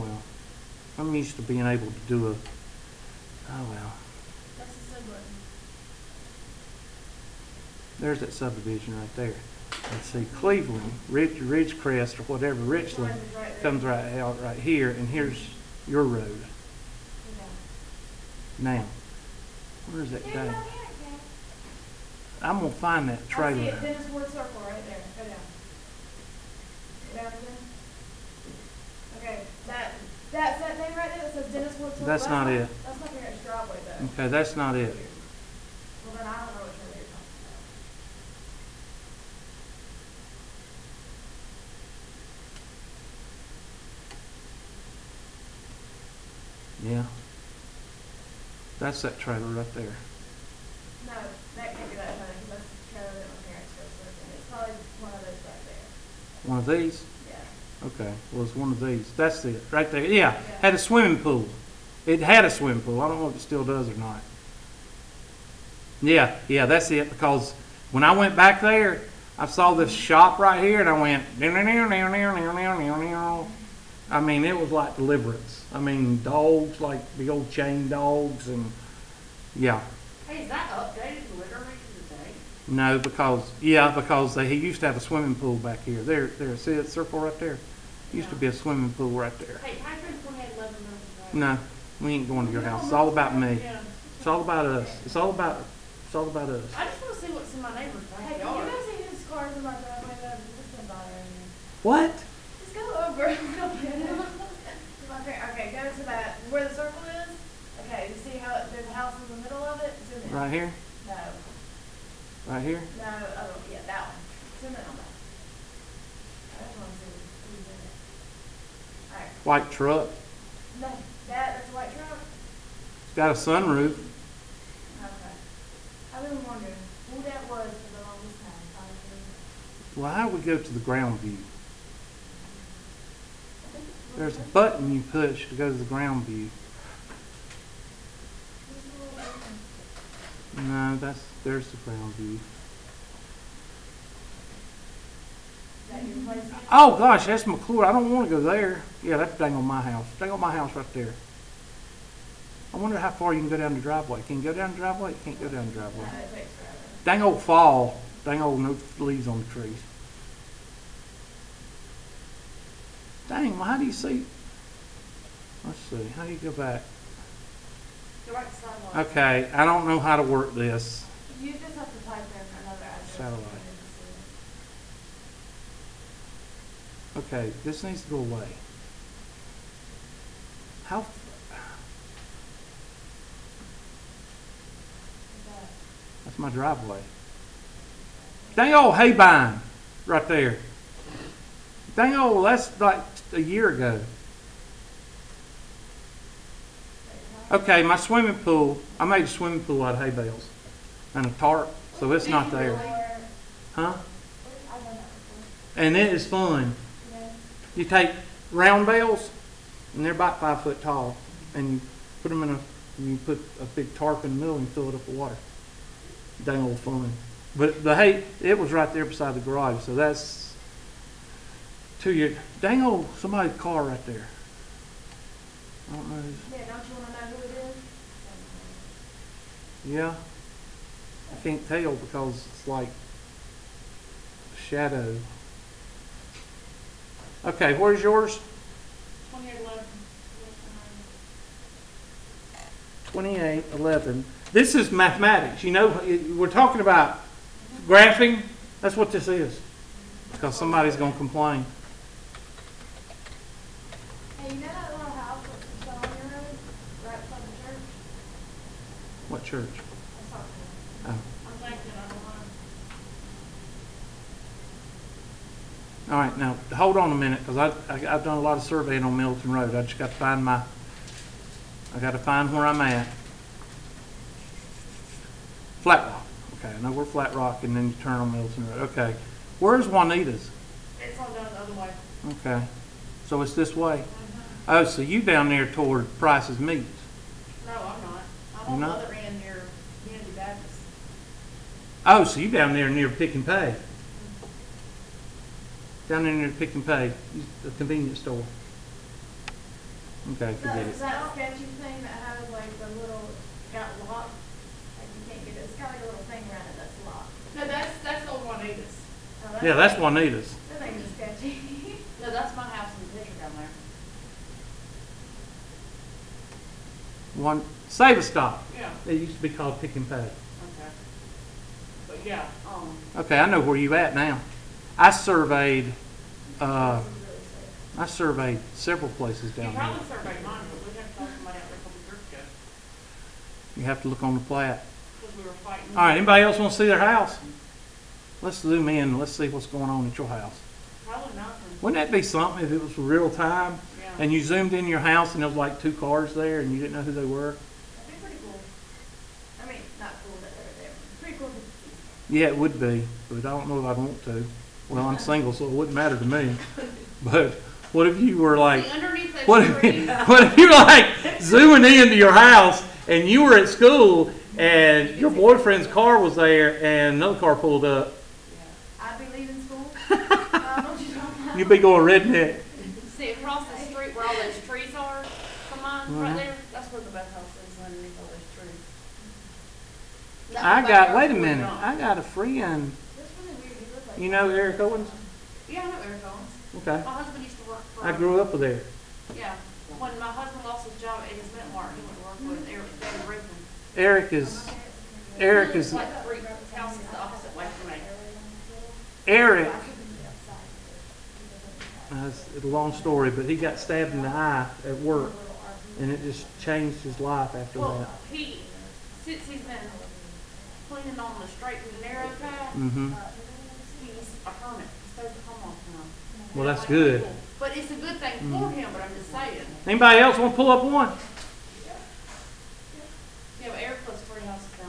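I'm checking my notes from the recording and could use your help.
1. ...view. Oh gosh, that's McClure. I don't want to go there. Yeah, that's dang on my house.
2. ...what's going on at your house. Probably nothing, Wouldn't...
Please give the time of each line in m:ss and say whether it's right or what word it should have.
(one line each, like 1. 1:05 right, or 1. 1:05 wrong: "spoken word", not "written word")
1. 2:22 right
2. 5:39 right.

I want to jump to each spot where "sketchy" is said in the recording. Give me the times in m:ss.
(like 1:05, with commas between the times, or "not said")
5:01, 5:11.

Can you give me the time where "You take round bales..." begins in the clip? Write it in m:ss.
3:27.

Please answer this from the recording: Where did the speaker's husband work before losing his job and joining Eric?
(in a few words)
Meat mart.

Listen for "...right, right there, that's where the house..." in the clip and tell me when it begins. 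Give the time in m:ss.
6:16.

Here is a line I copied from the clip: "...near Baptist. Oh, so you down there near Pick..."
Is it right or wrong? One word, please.
right.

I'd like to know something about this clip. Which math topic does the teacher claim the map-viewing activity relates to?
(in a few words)
Graphing.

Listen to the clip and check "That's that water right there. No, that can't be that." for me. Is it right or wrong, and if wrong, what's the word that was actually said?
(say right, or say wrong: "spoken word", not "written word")
wrong: "trailer", not "water".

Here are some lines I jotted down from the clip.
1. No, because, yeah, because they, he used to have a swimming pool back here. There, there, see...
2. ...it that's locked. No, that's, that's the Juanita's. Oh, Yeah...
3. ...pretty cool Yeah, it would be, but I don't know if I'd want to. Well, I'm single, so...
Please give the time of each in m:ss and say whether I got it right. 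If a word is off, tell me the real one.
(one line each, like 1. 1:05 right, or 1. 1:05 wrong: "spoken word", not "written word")
1. 1:22 right
2. 5:06 right
3. 5:51 right.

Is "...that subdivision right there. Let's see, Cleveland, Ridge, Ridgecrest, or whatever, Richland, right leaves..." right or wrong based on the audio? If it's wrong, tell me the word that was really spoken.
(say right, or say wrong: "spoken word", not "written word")
wrong: "comes", not "leaves".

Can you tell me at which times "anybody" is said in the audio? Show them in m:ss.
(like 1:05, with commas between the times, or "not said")
5:36, 6:59.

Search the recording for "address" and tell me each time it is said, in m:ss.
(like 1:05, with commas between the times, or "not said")
2:52.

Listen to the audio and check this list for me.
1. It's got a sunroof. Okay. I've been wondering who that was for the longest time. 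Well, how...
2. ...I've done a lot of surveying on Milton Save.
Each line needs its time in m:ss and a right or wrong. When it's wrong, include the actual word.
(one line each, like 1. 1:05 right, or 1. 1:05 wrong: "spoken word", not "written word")
1. 2:03 right
2. 4:28 wrong: "Road", not "Save".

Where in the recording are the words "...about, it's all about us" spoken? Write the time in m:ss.
1:35.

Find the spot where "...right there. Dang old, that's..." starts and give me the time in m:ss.
3:10.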